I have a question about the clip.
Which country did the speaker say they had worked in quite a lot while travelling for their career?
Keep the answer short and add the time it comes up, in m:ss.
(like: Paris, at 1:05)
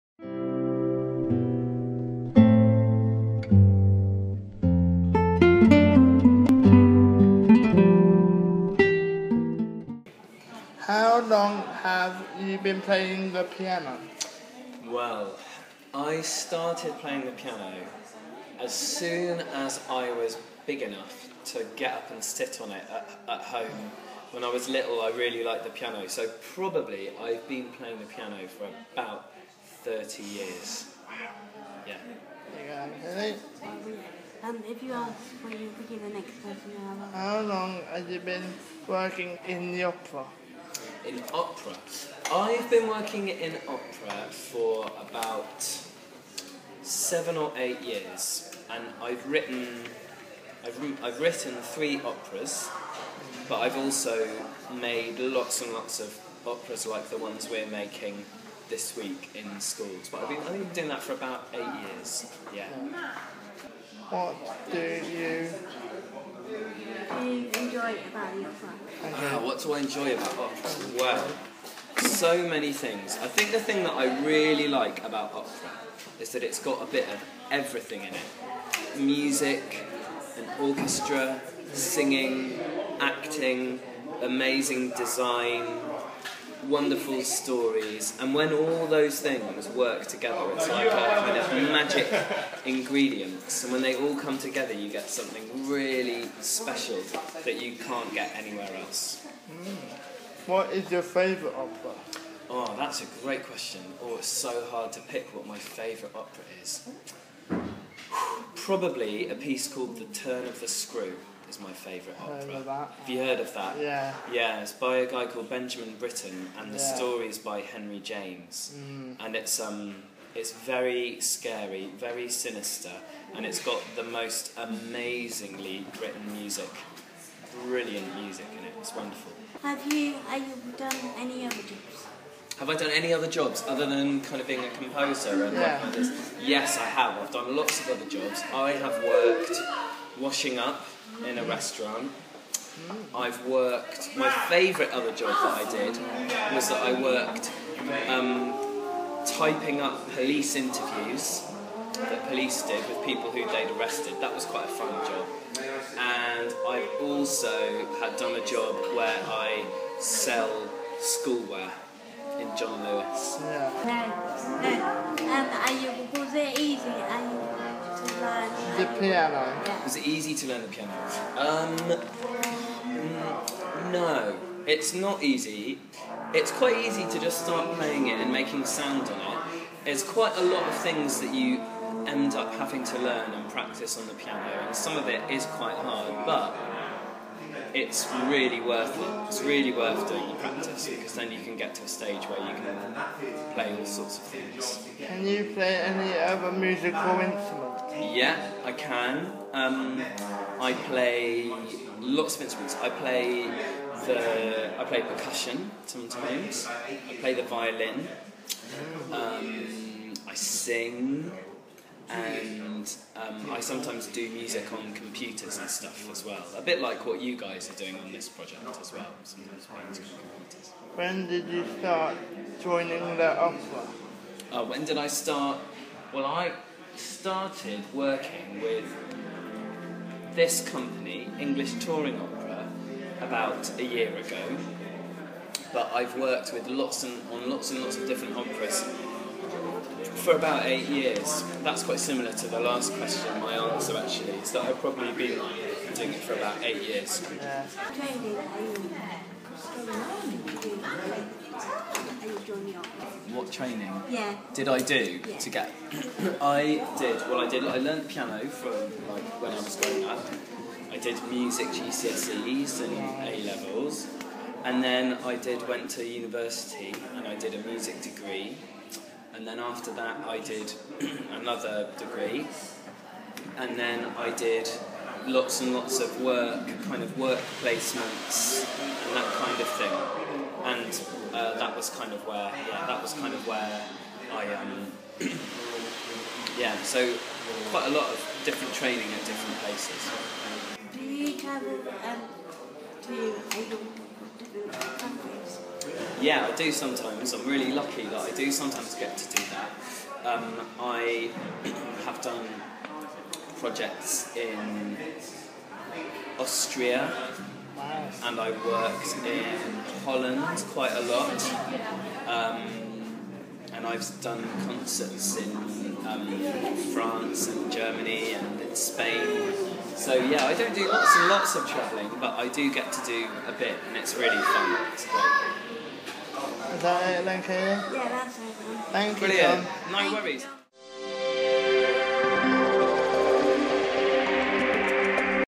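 Holland, at 5:10.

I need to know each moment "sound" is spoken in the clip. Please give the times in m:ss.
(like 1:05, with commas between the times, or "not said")
2:58.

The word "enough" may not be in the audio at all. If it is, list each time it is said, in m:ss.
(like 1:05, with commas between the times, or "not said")
0:20.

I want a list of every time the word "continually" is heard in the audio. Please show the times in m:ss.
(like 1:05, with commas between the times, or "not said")
not said.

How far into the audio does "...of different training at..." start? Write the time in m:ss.
4:48.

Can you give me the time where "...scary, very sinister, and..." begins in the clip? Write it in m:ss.
2:01.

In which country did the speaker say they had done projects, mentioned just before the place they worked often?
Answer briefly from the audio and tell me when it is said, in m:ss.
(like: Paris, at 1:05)
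Austria, at 5:06.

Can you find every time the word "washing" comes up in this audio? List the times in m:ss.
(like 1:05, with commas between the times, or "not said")
2:20.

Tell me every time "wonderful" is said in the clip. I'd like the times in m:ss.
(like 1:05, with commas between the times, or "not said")
1:26, 2:08.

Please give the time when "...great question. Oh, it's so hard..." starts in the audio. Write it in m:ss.
1:43.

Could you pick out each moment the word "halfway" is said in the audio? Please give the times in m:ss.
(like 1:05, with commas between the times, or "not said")
not said.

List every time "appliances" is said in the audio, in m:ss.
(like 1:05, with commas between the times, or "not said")
not said.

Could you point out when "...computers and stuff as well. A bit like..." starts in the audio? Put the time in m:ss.
3:34.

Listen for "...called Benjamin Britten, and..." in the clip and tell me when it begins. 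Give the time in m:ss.
1:55.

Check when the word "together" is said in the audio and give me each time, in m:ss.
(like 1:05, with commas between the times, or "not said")
1:30, 1:34.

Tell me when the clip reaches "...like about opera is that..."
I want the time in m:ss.
1:14.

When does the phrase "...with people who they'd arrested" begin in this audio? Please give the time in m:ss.
2:32.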